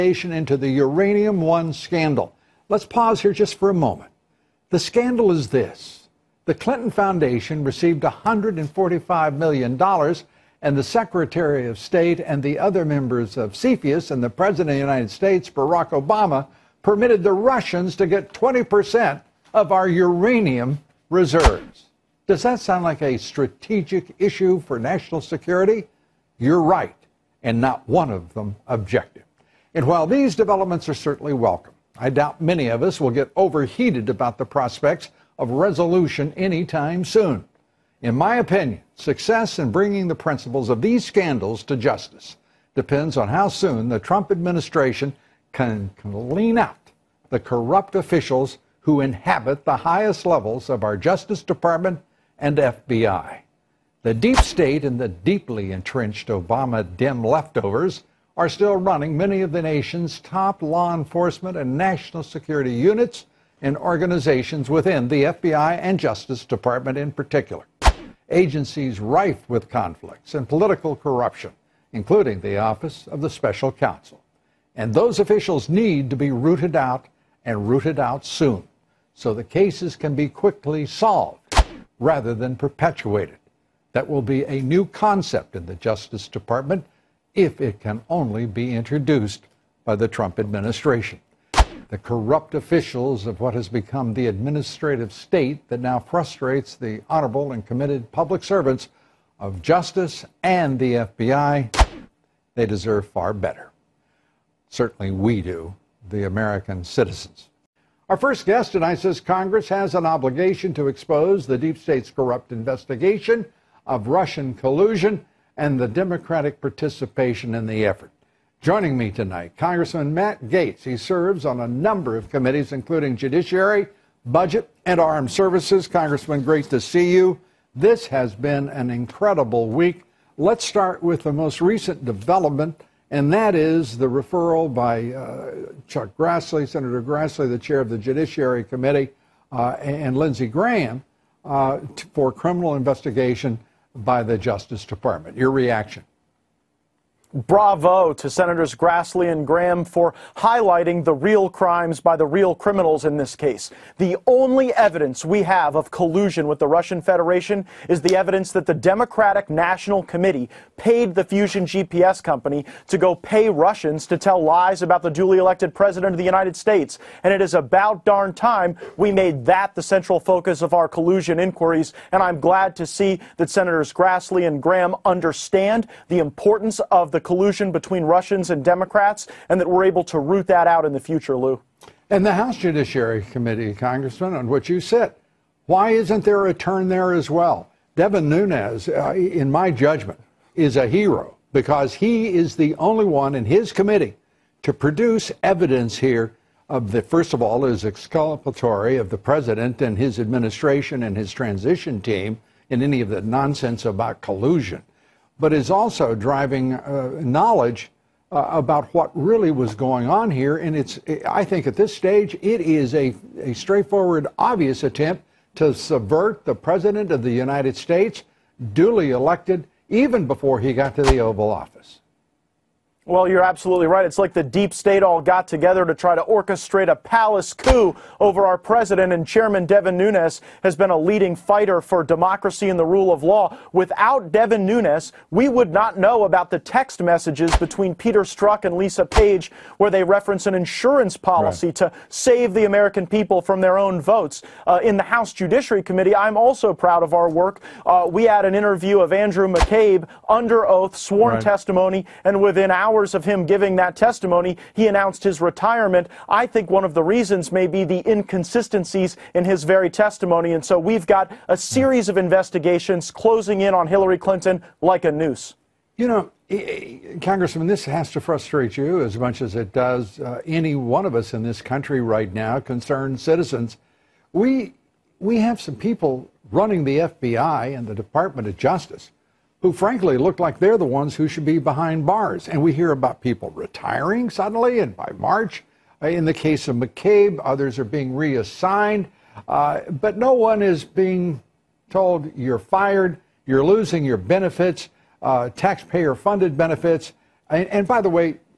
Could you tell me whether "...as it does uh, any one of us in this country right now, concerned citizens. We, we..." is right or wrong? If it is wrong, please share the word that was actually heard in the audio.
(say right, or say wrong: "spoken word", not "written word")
right.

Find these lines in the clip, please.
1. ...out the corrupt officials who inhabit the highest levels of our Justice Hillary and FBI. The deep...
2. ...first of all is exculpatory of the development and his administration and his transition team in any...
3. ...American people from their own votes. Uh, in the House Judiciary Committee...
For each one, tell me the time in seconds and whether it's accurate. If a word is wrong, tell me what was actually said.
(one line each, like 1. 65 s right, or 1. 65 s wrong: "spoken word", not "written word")
1. 46 s wrong: "Department", not "Hillary"
2. 197 s wrong: "president", not "development"
3. 242 s right.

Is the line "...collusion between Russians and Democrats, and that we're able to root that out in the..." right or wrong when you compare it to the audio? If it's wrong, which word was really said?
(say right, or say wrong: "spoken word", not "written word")
right.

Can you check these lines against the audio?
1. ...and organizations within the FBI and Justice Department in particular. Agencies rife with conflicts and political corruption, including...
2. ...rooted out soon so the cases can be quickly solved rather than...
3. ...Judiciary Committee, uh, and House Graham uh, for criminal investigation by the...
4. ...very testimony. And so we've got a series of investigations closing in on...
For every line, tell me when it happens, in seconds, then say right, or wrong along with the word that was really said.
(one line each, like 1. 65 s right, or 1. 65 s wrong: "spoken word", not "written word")
1. 63 s right
2. 77 s right
3. 137 s wrong: "Lindsey", not "House"
4. 259 s right.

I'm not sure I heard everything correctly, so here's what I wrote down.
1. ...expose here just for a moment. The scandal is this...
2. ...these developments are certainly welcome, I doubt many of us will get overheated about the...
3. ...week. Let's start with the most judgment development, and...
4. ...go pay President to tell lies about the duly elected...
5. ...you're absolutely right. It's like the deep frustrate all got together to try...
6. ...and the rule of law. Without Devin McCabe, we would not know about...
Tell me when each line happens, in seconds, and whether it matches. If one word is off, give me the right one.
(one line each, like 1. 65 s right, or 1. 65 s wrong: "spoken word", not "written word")
1. 2 s wrong: "pause", not "expose"
2. 30 s right
3. 129 s wrong: "recent", not "judgment"
4. 162 s wrong: "Russians", not "President"
5. 223 s wrong: "state", not "frustrate"
6. 232 s wrong: "Nunes", not "McCabe".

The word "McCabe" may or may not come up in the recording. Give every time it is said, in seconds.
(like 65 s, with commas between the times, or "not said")
249 s, 286 s.